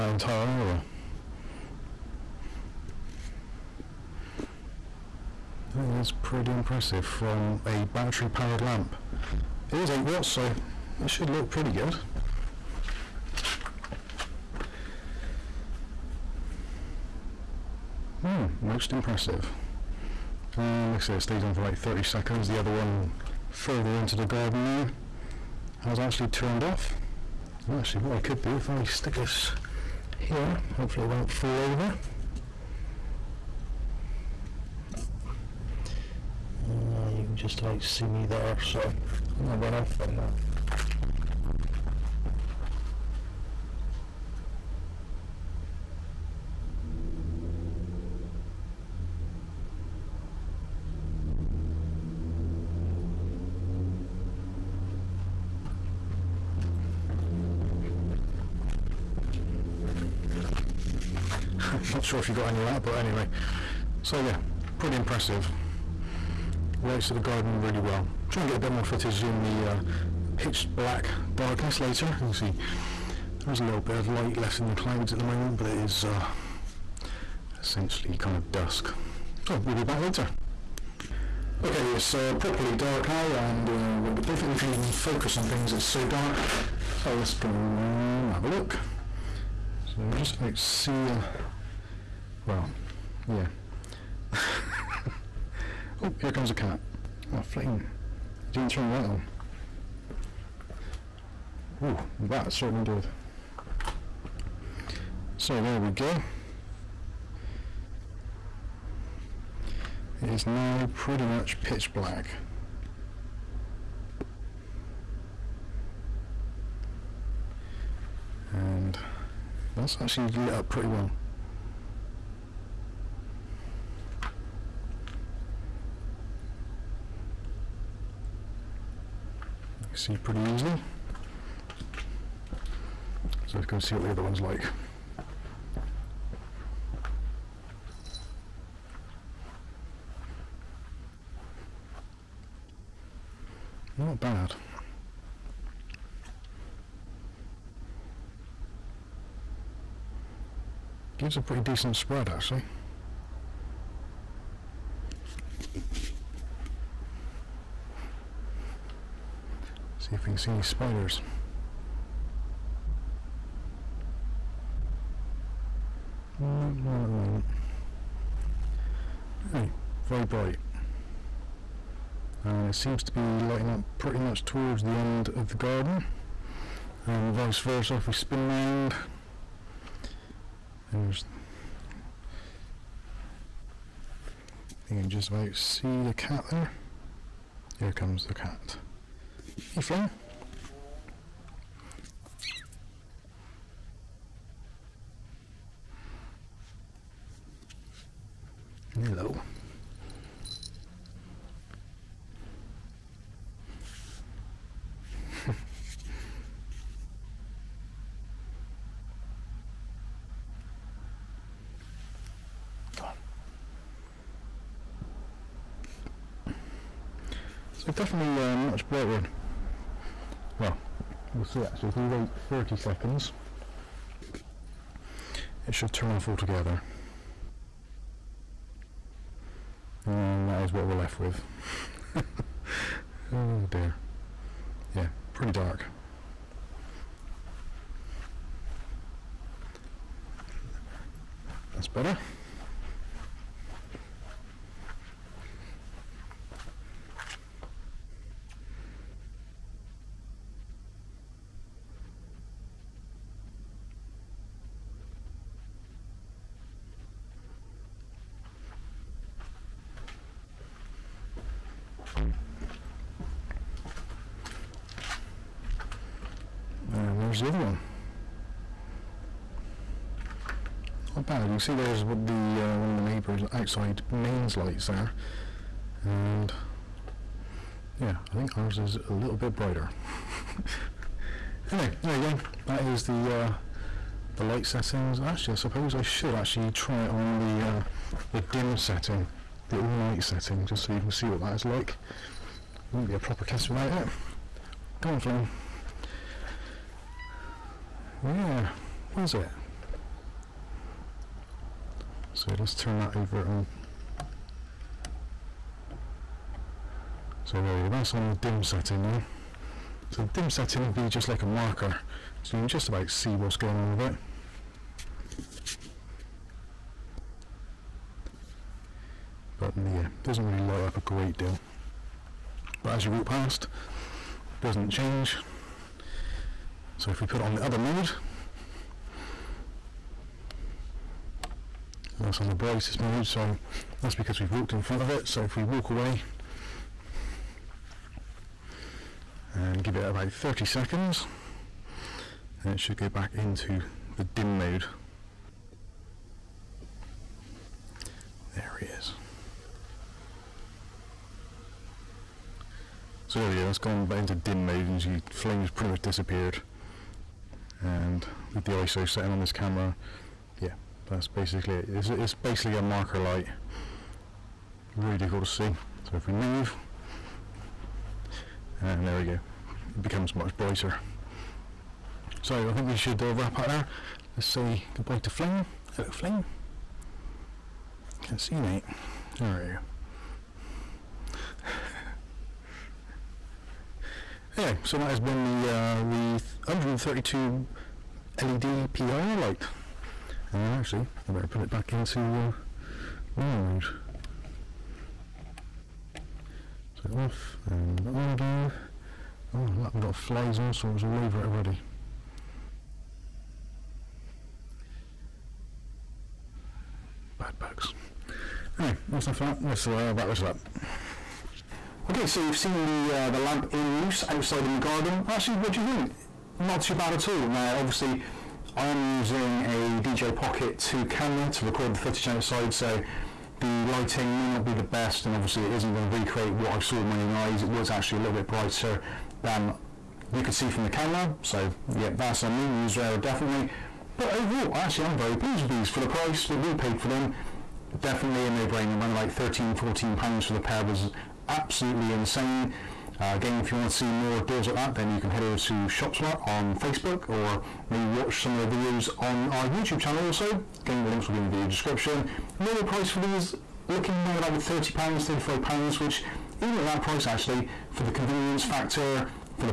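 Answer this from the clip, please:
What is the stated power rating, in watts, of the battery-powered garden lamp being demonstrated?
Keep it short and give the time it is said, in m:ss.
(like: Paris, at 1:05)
8 watts, at 0:09.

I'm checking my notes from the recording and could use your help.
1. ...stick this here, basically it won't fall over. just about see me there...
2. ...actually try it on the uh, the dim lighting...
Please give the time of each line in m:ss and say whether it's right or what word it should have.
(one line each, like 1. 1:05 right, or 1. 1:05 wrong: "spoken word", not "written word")
1. 0:28 wrong: "hopefully", not "basically"
2. 4:46 wrong: "setting", not "lighting".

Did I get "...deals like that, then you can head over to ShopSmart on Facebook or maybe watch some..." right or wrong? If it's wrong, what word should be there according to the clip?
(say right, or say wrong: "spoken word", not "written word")
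right.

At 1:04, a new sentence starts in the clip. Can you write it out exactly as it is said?
So yeah, pretty impressive lights of the garden really well.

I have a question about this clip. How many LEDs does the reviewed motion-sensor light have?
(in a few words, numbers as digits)
132.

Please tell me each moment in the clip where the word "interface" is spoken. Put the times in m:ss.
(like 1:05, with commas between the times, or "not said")
not said.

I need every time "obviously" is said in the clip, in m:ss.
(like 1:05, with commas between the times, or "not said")
6:57, 7:05.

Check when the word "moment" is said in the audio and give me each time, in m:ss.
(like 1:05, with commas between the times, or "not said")
1:15, 2:47.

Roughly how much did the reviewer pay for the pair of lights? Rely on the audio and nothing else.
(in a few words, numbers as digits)
£13-14.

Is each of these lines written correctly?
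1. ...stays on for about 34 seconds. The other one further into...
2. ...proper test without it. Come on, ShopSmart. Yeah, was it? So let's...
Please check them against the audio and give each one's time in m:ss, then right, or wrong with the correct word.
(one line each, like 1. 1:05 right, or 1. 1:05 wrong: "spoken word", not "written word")
1. 0:21 wrong: "30", not "34"
2. 4:53 wrong: "Flame", not "ShopSmart".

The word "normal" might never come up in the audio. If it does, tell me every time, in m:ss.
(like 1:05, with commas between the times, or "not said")
6:33, 7:32.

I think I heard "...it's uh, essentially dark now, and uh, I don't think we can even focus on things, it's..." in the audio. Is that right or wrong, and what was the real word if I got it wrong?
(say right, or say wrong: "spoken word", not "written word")
wrong: "properly", not "essentially".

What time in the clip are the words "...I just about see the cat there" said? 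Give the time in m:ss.
3:05.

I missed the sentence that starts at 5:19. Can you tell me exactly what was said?
But mm, yeah, doesn't really light up a great deal.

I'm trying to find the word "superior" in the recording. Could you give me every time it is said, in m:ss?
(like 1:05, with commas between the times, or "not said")
not said.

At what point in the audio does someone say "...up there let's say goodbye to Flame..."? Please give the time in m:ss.
6:13.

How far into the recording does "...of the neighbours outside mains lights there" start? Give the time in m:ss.
4:32.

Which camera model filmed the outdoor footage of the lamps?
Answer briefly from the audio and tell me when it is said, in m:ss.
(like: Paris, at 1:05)
DJI Pocket 2, at 7:00.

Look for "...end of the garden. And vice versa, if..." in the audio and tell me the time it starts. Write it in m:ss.
2:54.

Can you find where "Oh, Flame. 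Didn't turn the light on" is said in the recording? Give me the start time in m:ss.
1:37.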